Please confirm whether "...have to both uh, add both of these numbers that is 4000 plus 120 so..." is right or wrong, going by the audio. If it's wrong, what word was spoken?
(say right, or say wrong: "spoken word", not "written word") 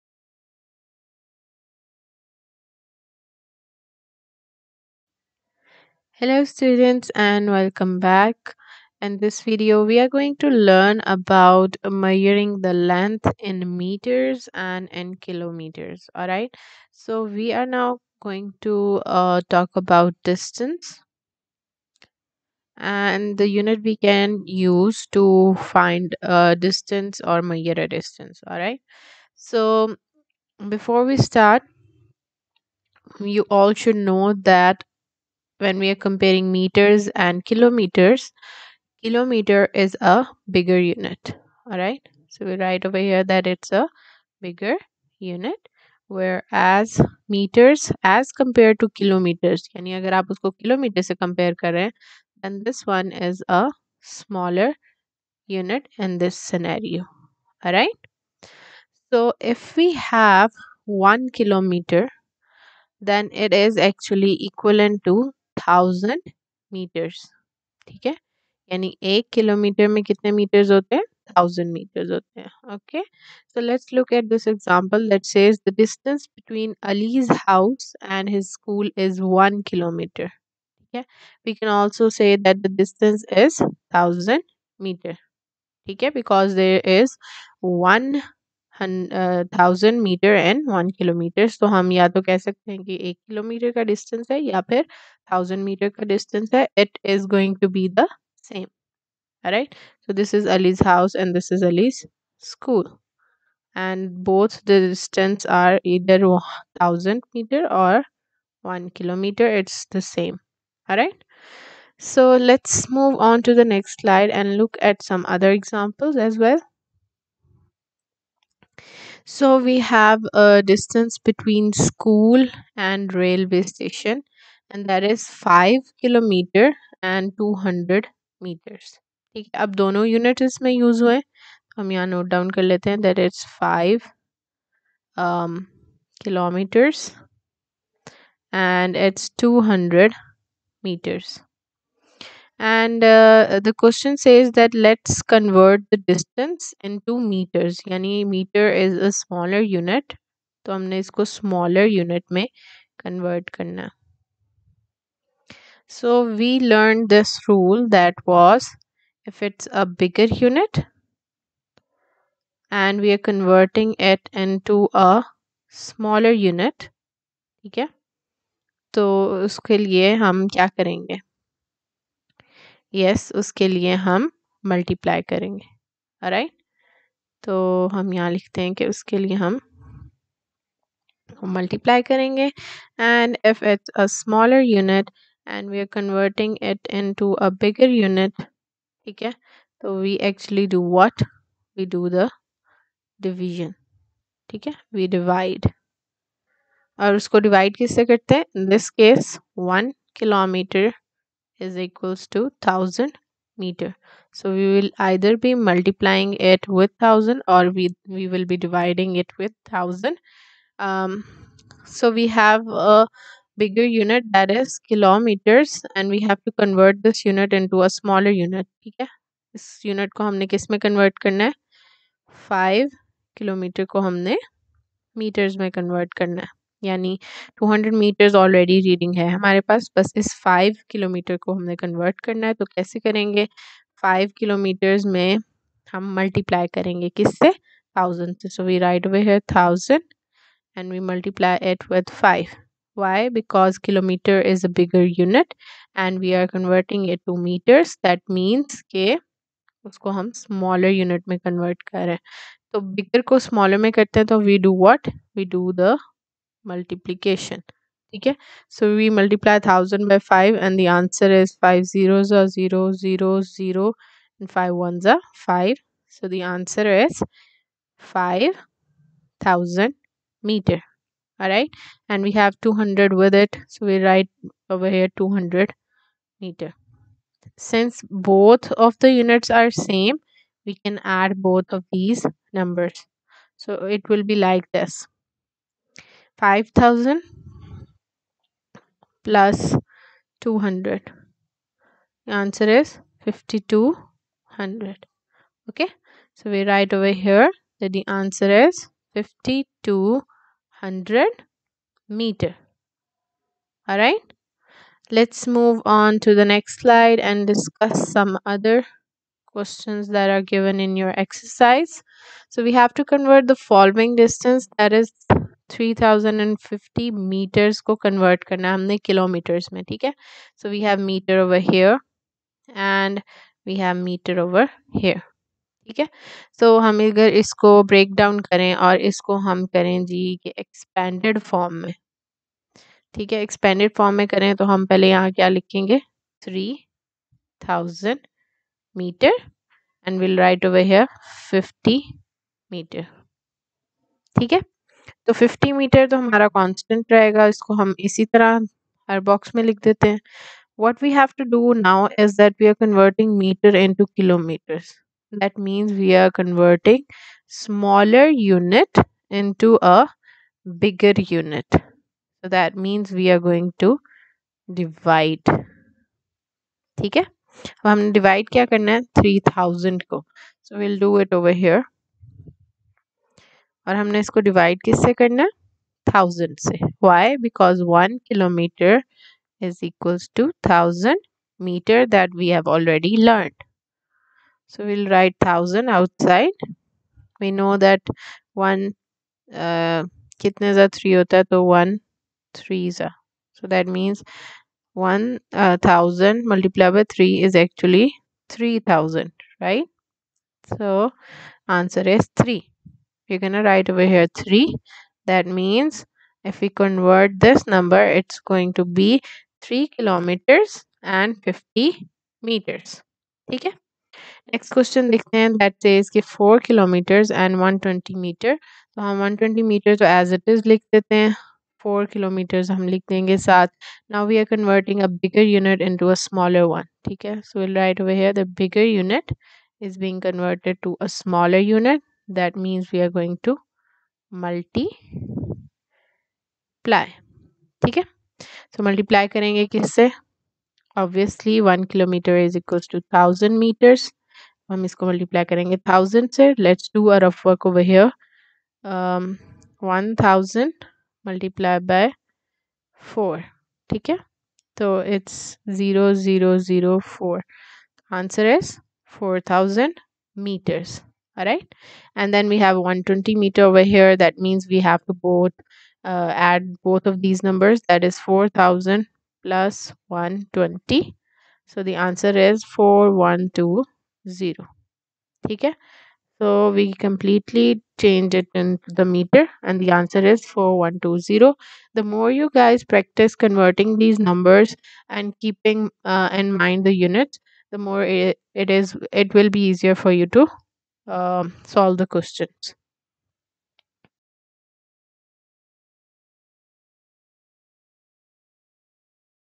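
right.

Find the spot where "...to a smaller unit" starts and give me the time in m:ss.
7:10.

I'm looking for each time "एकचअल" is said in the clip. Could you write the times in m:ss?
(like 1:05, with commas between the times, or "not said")
3:10, 6:37.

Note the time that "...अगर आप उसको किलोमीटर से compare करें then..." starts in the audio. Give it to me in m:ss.
0:49.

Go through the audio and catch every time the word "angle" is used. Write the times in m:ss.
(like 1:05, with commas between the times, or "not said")
not said.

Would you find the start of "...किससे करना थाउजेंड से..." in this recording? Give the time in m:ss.
6:14.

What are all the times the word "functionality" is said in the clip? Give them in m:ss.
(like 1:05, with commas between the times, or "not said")
not said.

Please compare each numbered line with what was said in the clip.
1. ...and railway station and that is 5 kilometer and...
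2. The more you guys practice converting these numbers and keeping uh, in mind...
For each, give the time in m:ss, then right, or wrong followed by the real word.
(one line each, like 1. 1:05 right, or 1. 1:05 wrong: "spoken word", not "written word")
1. 2:02 right
2. 8:01 right.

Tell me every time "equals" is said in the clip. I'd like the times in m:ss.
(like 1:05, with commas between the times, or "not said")
3:21.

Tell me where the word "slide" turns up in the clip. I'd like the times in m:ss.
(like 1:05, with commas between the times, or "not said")
1:54, 5:06.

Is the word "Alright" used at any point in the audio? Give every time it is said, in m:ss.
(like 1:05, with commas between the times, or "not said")
0:16, 0:28.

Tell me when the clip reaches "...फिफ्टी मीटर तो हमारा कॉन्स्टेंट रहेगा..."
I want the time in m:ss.
5:45.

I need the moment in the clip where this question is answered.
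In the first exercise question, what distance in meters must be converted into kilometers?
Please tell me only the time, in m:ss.
5:15.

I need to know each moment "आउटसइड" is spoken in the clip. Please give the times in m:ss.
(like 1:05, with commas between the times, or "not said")
6:25.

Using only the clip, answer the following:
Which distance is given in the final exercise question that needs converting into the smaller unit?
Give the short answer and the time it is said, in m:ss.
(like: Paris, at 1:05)
4 kilometers and 120 meters, at 6:56.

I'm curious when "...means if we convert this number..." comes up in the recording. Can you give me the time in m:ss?
6:45.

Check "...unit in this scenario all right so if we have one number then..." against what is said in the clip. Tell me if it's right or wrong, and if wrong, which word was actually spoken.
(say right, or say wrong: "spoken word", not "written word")
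wrong: "kilometer", not "number".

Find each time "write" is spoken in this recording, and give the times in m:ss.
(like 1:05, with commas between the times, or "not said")
0:42, 4:34, 4:56, 6:43, 7:07.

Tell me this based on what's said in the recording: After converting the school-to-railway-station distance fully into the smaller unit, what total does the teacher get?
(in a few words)
5200 meters.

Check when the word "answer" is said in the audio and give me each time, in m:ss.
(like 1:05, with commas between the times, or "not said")
4:20, 4:26, 4:52, 4:58, 7:51, 7:59.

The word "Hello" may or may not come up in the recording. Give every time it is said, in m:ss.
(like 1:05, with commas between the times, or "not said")
0:06.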